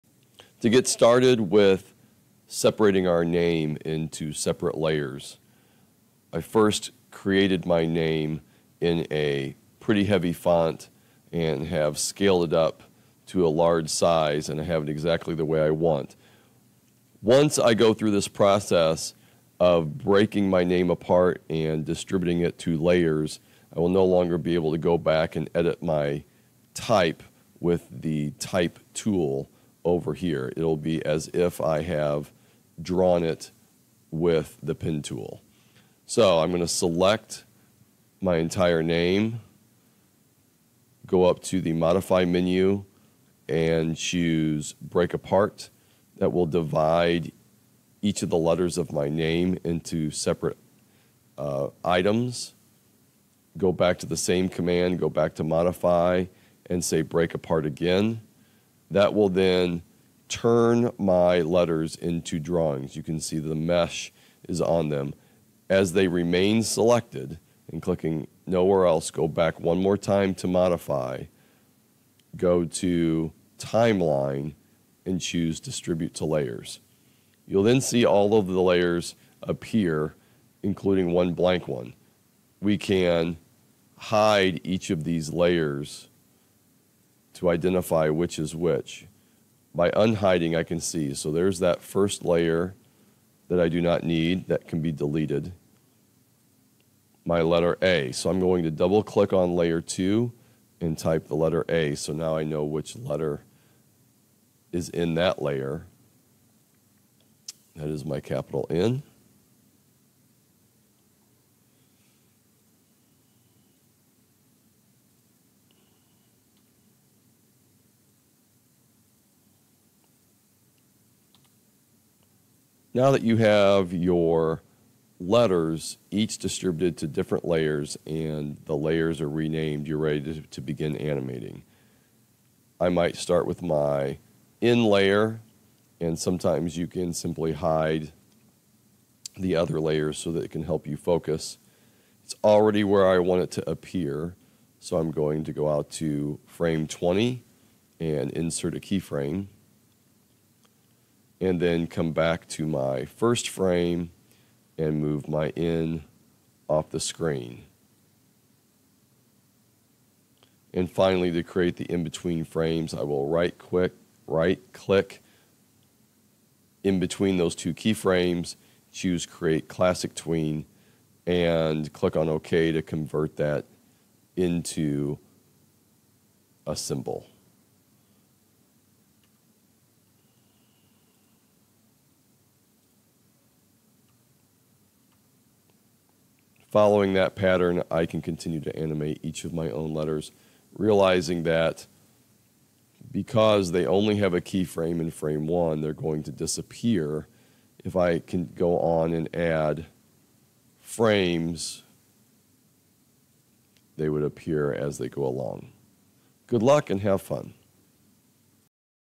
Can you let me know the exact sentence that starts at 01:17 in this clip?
You'll then see all of the layers appear, including one blank one.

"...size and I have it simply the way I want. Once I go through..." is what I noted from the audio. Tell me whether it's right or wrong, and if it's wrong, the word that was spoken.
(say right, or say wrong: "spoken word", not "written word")
wrong: "exactly", not "simply".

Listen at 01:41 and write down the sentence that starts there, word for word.
So now I know which letter is in that layer.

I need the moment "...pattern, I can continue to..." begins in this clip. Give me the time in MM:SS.
03:07.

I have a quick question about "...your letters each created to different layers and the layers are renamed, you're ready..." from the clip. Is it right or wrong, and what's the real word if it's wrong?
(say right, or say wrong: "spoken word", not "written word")
wrong: "distributed", not "created".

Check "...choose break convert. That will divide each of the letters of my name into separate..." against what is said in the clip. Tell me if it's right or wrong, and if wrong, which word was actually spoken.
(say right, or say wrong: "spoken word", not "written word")
wrong: "apart", not "convert".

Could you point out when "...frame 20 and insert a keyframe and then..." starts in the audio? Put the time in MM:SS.
02:26.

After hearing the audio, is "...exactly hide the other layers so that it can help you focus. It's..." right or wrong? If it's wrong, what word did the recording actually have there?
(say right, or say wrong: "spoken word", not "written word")
wrong: "simply", not "exactly".